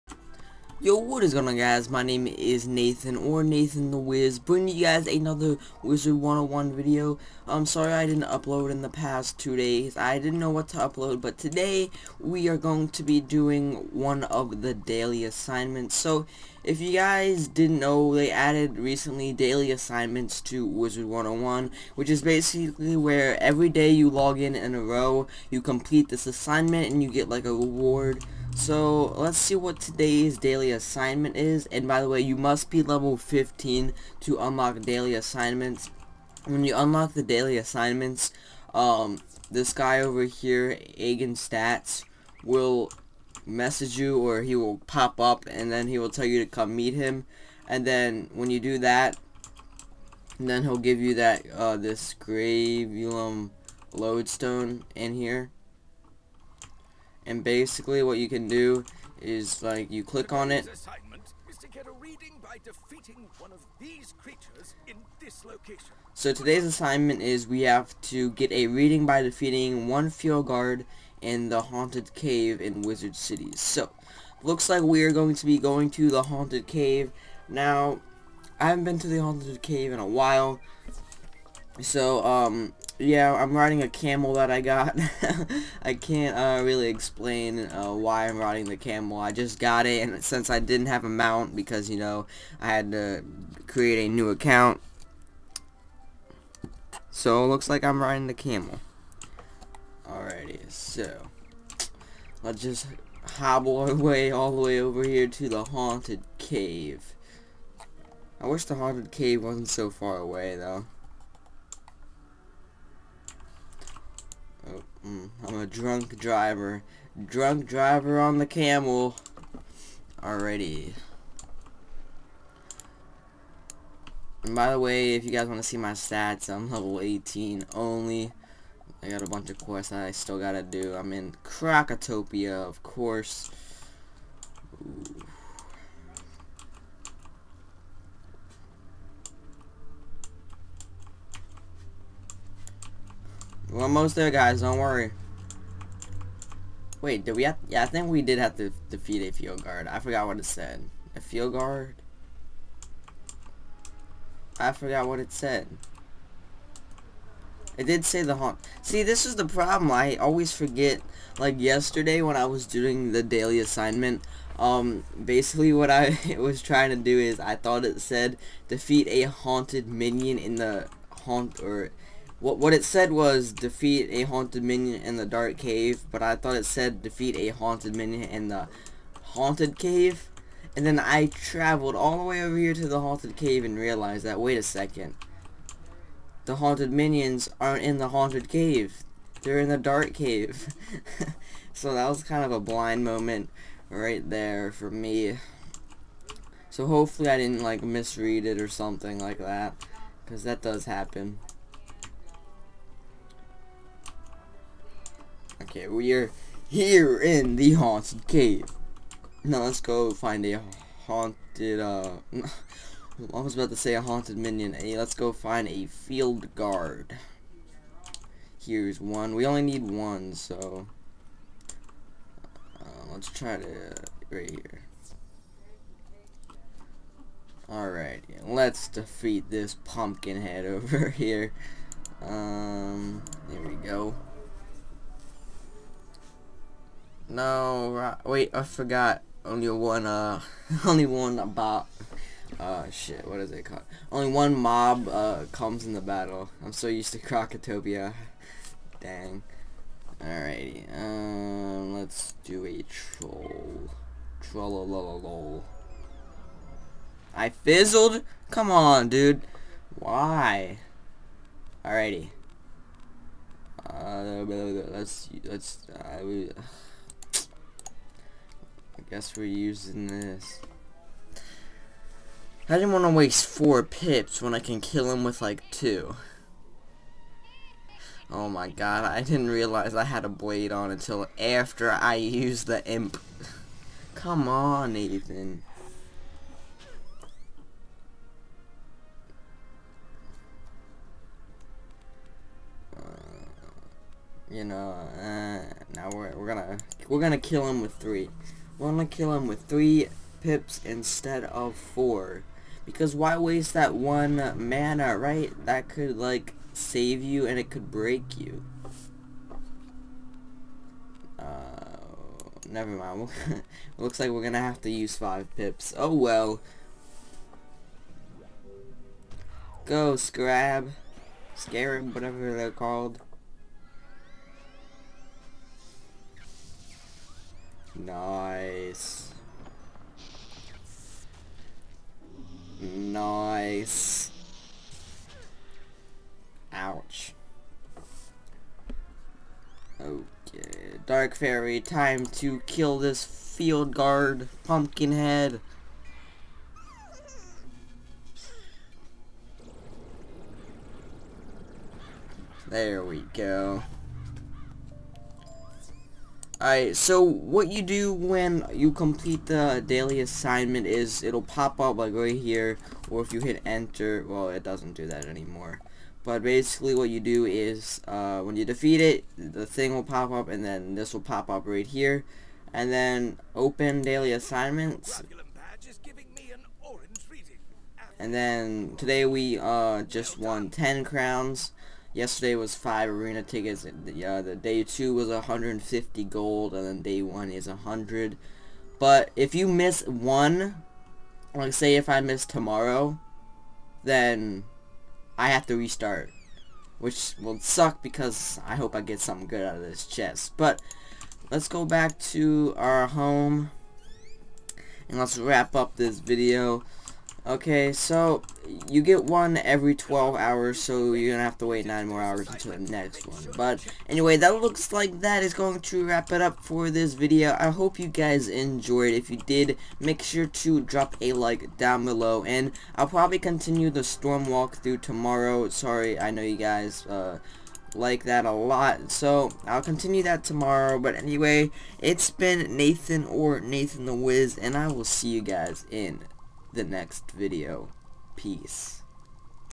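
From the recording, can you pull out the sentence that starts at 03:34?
Hey, let's go find a field guard.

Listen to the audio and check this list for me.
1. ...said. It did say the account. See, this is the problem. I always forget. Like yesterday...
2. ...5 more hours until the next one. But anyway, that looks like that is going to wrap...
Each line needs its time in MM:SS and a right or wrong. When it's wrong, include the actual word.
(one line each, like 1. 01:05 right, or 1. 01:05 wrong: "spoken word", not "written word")
1. 02:35 wrong: "haunt", not "account"
2. 06:51 wrong: "9", not "5".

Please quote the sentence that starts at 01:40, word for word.
Alrighty, so, let's just hobble our way all the way over here to the haunted cave.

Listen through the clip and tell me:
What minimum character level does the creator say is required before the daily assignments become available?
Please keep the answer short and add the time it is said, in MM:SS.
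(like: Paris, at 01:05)
15, at 00:32.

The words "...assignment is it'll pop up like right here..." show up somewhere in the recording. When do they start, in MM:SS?
06:00.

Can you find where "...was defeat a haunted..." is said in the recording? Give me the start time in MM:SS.
02:53.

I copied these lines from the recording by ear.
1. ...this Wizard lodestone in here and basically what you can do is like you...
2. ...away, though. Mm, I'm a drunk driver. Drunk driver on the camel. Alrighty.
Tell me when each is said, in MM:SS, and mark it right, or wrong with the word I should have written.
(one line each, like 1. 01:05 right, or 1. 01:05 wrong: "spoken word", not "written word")
1. 00:51 wrong: "Gravulum", not "Wizard"
2. 01:50 right.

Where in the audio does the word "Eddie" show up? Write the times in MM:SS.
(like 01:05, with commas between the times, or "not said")
not said.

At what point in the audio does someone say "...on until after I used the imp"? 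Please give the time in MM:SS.
04:40.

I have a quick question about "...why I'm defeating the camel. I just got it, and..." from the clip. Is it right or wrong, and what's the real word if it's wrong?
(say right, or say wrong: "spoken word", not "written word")
wrong: "riding", not "defeating".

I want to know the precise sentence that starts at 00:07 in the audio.
I'm sorry I didn't upload in the past two days.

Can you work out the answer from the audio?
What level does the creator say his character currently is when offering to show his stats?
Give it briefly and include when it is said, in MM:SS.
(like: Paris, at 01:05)
18, at 02:06.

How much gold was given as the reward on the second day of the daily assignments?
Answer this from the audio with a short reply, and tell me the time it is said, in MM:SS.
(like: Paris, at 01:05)
150 gold, at 06:25.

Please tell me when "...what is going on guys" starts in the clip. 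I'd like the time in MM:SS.
00:00.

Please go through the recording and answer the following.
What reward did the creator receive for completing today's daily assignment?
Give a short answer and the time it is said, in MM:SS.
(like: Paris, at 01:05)
10 crowns, at 06:20.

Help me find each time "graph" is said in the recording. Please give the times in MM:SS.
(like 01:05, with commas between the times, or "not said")
not said.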